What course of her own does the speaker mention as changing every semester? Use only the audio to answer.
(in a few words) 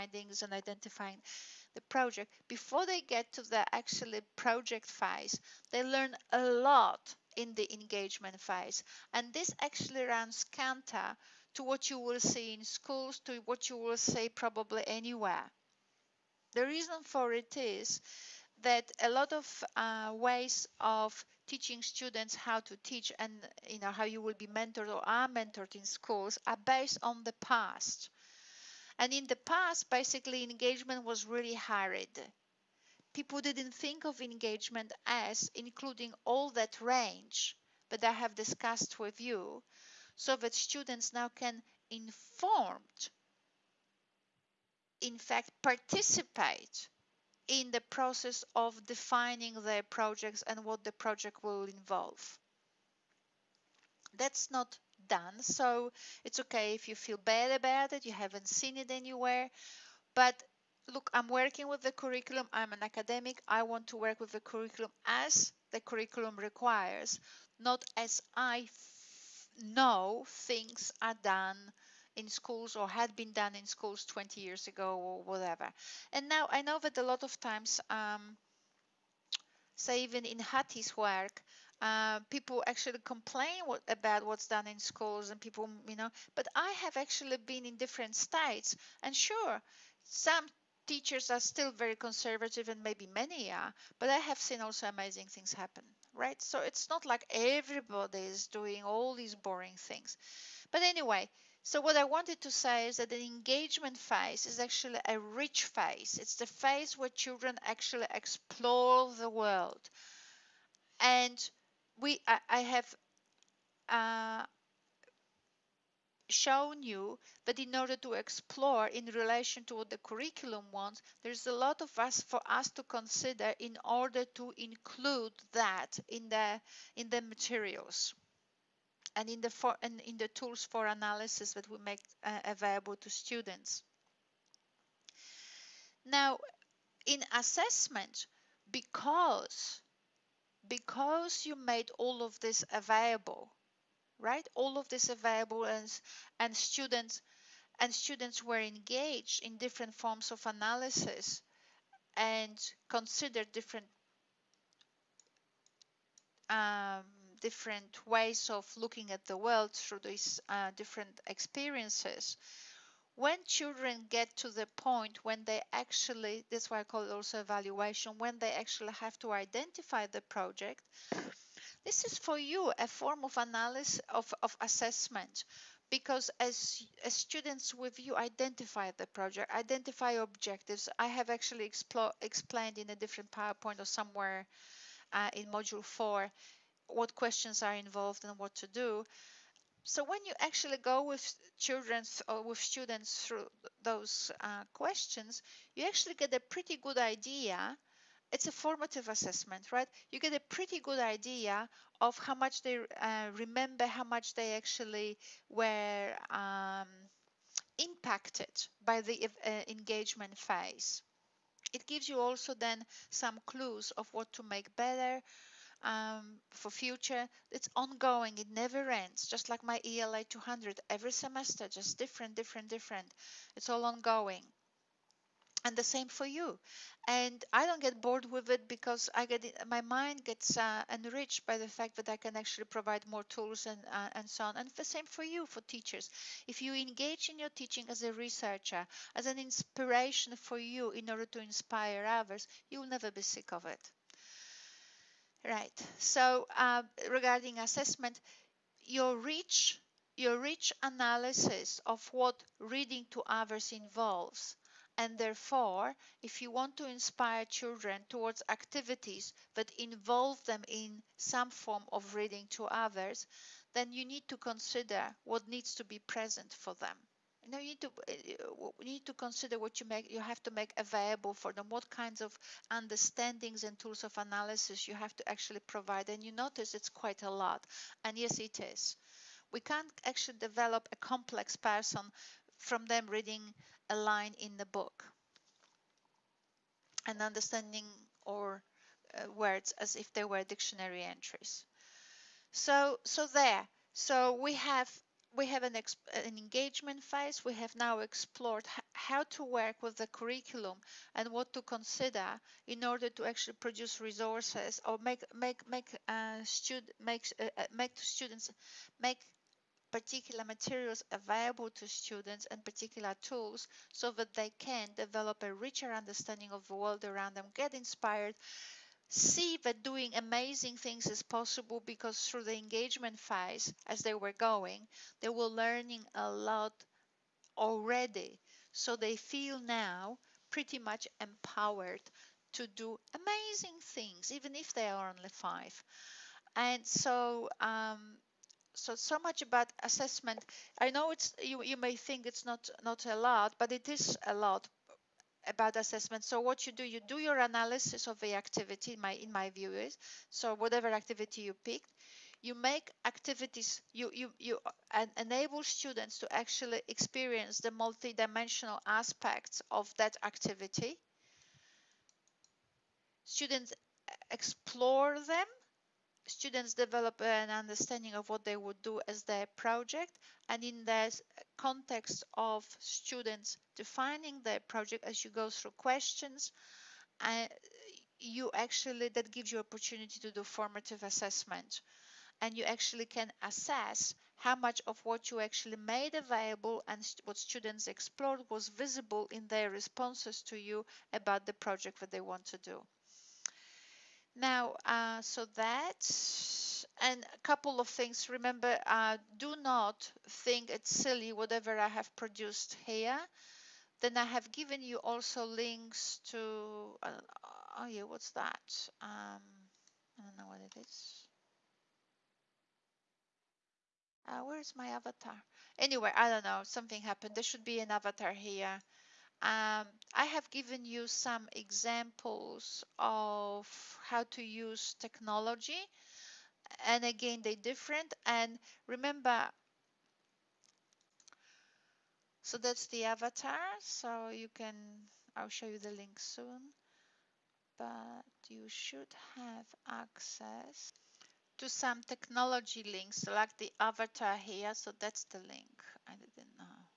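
ELA 200.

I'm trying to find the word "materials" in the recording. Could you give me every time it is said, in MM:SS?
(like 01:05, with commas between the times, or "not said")
02:07, 05:10.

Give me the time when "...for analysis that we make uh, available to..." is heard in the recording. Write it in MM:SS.
02:10.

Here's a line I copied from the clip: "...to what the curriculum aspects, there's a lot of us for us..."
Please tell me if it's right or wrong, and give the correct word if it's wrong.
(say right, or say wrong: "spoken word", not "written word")
wrong: "wants", not "aspects".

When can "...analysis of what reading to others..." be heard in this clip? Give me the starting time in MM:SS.
04:10.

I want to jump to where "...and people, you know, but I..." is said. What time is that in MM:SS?
01:25.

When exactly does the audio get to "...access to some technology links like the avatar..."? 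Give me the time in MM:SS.
07:19.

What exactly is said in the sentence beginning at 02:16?
Now, in assessment, because because you made all of this available, right?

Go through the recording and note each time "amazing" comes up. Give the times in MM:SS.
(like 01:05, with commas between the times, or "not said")
01:34, 05:20, 05:33.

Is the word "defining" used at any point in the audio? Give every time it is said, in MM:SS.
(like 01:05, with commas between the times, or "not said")
00:48, 06:13.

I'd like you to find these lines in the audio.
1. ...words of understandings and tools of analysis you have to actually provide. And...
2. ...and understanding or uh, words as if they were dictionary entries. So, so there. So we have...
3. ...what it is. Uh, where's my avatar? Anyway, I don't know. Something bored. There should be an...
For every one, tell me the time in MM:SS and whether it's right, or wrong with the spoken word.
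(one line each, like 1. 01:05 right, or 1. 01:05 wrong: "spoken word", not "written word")
1. 04:31 wrong: "kinds", not "words"
2. 04:47 right
3. 06:50 wrong: "happened", not "bored".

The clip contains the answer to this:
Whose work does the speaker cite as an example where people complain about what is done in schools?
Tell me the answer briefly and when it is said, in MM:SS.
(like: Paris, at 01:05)
Hattie, at 01:20.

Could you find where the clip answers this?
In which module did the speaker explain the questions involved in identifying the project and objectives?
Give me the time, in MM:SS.
03:05.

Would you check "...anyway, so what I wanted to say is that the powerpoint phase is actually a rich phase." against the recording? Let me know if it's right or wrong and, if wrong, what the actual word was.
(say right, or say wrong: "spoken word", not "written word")
wrong: "engagement", not "powerpoint".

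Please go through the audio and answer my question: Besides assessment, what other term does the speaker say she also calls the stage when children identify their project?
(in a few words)
evaluation.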